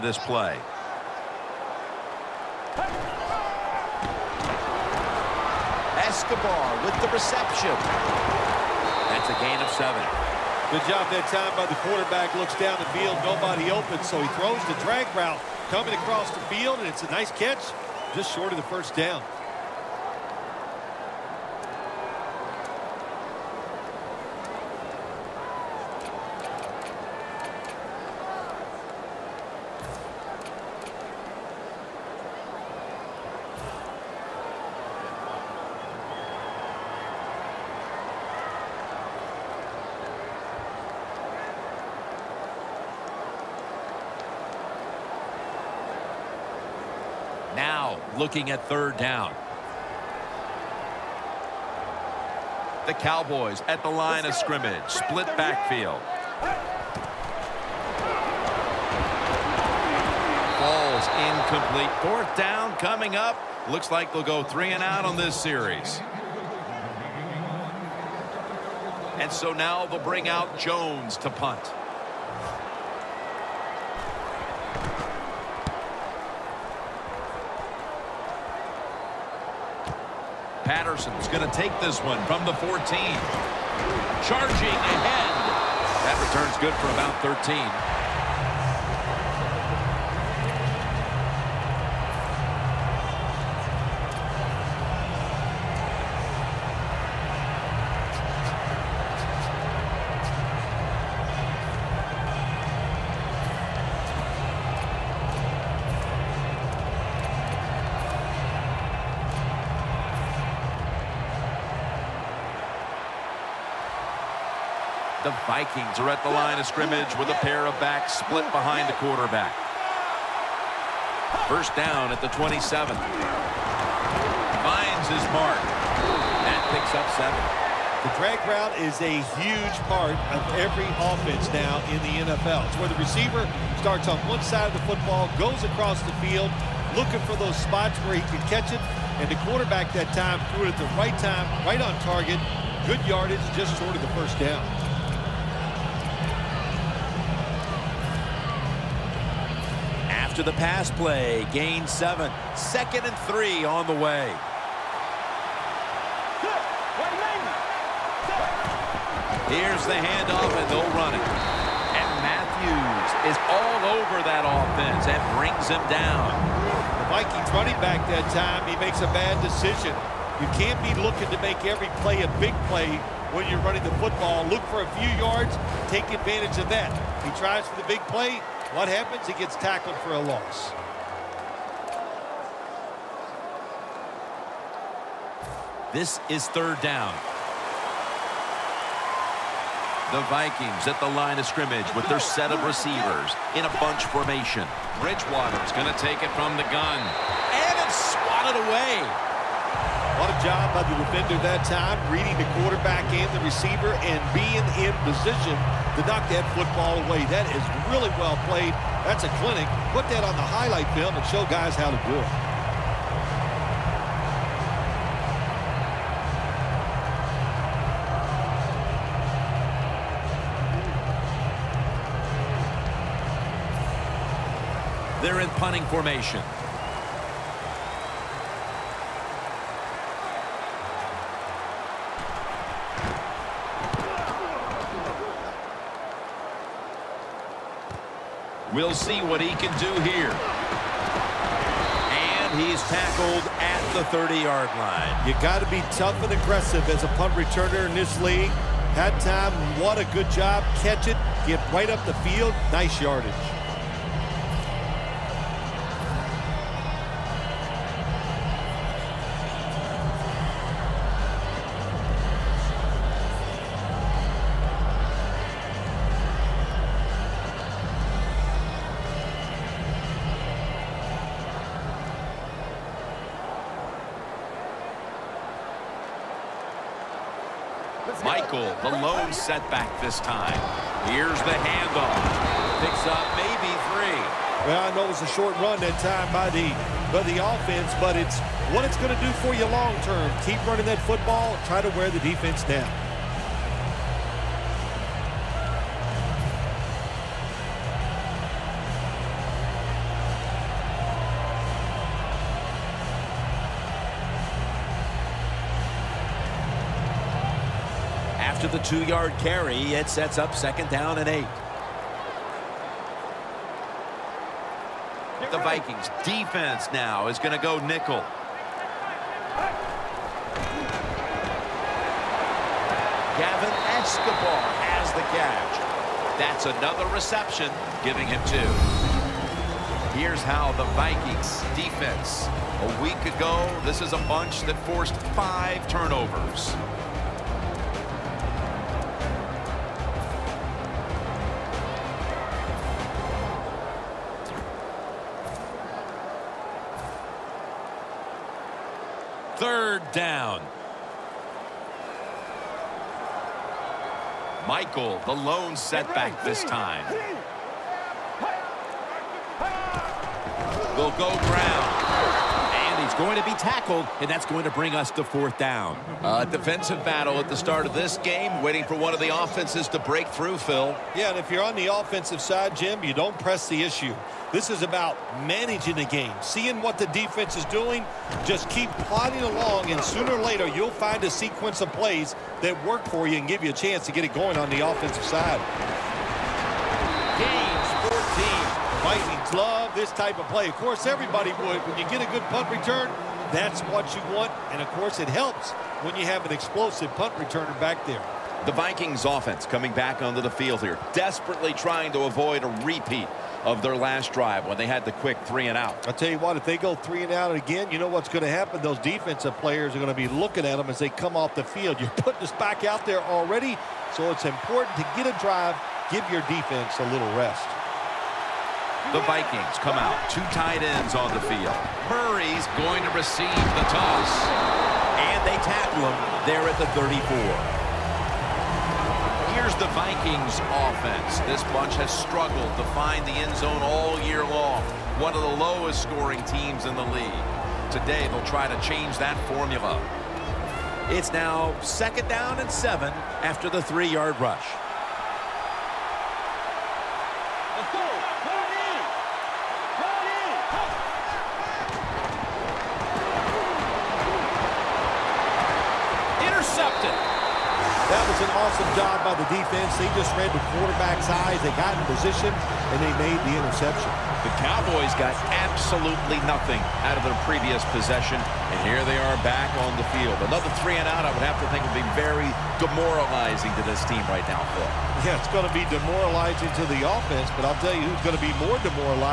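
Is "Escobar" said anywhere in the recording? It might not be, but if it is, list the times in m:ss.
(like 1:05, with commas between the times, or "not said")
0:06, 5:24.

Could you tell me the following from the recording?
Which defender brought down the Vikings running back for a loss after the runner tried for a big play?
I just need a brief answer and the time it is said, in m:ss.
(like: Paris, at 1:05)
Matthews, at 2:42.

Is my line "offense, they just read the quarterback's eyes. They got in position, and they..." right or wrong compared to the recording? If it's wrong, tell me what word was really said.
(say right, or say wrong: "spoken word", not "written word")
wrong: "defense", not "offense".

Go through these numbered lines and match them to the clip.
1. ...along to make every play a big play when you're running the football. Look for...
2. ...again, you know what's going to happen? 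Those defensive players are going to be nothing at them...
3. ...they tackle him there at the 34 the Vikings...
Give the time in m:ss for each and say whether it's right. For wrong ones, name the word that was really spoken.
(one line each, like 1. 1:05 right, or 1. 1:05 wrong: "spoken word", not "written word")
1. 2:51 wrong: "looking", not "along"
2. 6:47 wrong: "looking", not "nothing"
3. 7:05 right.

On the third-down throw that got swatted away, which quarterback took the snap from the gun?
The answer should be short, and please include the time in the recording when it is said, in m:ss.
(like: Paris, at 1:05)
Bridgewater, at 3:15.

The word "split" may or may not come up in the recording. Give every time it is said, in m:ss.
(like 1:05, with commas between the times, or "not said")
0:54, 1:58.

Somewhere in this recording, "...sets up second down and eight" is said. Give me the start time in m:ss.
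5:10.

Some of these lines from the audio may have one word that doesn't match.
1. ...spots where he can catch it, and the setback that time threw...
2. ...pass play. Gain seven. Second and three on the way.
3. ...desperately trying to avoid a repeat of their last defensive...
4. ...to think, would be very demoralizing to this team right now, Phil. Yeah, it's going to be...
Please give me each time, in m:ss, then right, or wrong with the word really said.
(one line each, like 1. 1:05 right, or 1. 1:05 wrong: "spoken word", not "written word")
1. 2:17 wrong: "quarterback", not "setback"
2. 2:30 right
3. 6:41 wrong: "drive", not "defensive"
4. 7:51 right.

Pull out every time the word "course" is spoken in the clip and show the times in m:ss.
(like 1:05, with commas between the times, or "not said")
6:30, 6:34.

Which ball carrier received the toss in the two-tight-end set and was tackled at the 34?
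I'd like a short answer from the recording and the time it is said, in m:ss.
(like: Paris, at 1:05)
Murray, at 7:02.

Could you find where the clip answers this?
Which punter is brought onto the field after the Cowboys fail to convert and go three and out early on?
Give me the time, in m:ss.
1:10.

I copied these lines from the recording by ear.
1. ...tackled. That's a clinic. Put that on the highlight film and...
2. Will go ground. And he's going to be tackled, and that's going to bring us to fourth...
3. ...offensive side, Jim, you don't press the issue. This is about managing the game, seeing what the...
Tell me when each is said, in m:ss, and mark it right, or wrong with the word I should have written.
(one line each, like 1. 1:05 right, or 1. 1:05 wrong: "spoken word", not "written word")
1. 3:28 wrong: "played", not "tackled"
2. 6:00 right
3. 6:11 right.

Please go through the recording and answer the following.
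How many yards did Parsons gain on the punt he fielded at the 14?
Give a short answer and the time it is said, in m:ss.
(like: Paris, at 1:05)
13, at 1:26.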